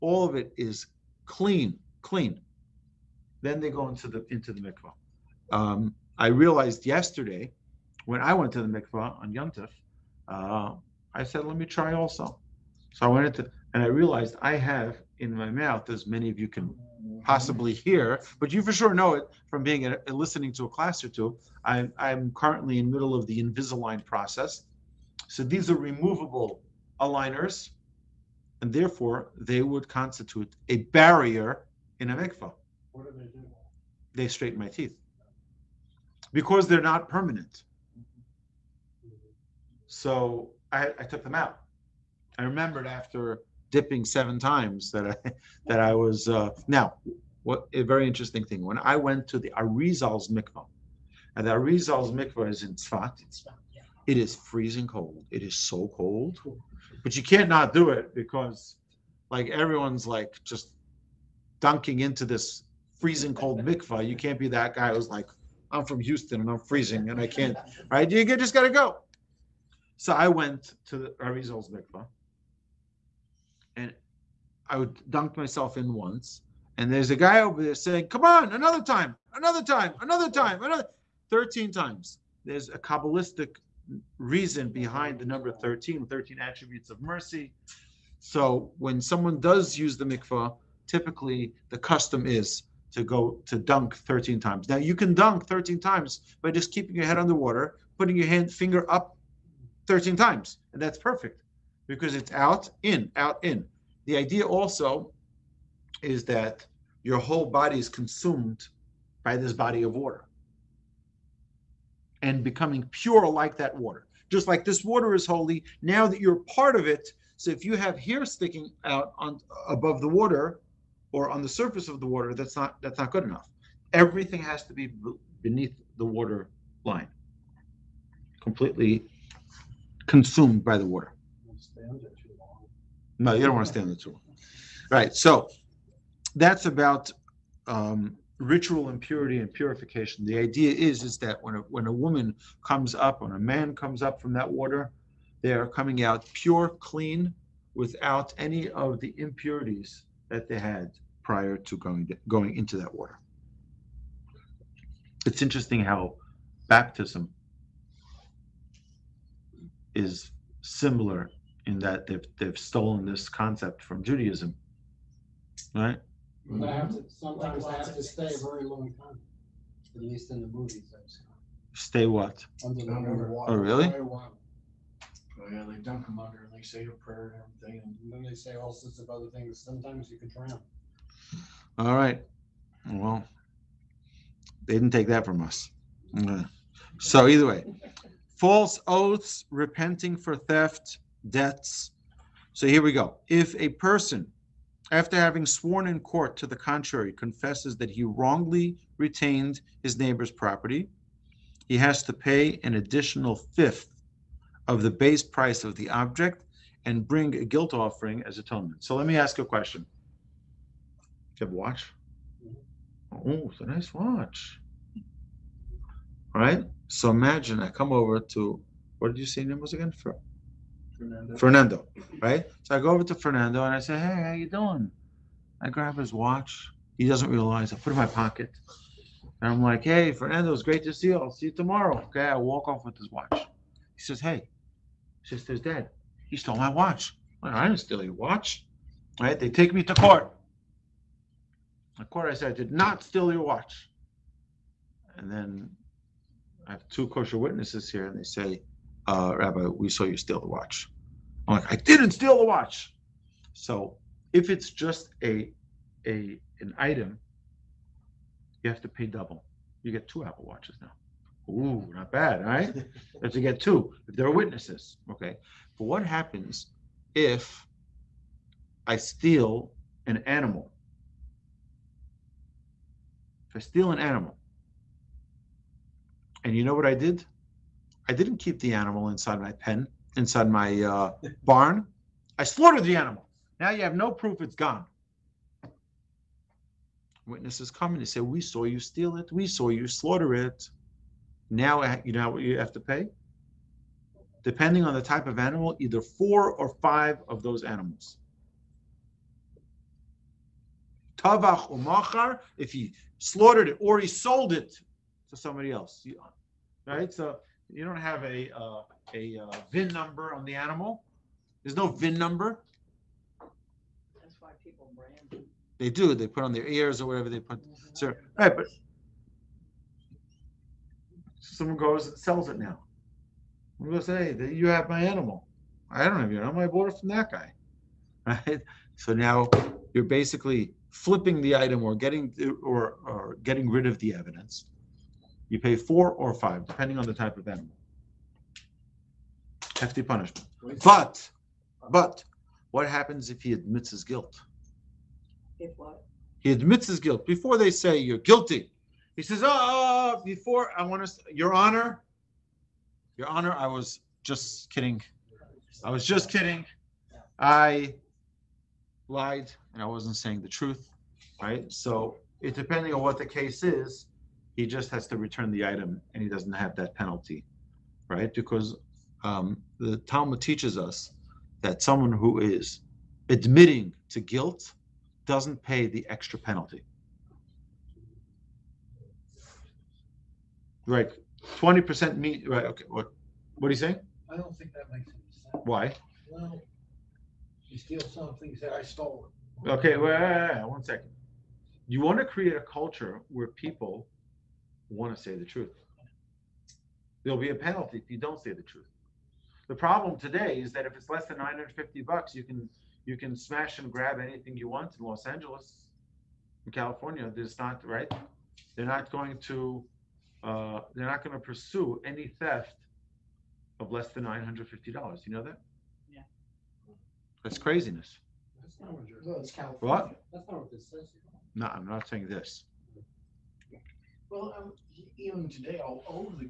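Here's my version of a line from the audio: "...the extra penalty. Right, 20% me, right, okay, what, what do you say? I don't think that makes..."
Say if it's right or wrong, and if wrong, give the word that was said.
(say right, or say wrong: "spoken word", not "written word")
right.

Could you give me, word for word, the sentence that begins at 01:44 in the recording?
The idea also is that your whole body is consumed by this body of water and becoming pure like that water.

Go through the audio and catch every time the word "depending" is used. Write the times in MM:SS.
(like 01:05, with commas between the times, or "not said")
04:54, 05:36, 06:02.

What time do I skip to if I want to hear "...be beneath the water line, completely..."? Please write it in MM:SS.
02:04.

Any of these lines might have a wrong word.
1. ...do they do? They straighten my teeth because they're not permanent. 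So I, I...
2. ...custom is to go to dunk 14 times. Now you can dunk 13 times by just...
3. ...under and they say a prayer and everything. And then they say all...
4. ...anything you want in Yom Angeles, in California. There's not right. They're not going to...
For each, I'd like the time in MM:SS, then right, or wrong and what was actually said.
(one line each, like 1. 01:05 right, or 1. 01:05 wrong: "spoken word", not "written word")
1. 00:33 right
2. 01:31 wrong: "13", not "14"
3. 02:56 right
4. 06:44 wrong: "Los", not "Yom".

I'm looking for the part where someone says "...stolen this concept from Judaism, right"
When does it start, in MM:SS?
02:42.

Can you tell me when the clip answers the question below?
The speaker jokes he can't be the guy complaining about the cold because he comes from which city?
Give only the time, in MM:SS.
01:06.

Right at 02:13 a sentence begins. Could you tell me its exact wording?
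No, you don't want to stand there too long.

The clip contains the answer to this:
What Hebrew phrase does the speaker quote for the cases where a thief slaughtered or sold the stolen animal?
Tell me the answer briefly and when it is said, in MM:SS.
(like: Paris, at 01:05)
Tavach umachar, at 05:01.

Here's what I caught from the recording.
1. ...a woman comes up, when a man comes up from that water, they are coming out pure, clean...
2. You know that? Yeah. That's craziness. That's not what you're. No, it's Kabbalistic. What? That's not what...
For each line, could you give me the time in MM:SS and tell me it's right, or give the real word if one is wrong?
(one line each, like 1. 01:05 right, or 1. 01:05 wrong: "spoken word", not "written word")
1. 02:21 right
2. 06:55 wrong: "California", not "Kabbalistic".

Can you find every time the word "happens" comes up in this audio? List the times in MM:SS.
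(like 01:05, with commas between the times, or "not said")
04:26, 05:42.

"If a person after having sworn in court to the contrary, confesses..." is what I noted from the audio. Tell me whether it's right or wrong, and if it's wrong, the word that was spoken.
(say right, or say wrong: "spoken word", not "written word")
right.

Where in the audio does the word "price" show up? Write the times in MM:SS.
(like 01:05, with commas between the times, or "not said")
03:25.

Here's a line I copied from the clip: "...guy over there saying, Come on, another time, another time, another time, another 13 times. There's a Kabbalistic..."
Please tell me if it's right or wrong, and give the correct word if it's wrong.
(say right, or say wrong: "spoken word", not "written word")
right.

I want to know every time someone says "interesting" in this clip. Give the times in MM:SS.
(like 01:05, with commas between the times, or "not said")
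00:48, 02:35.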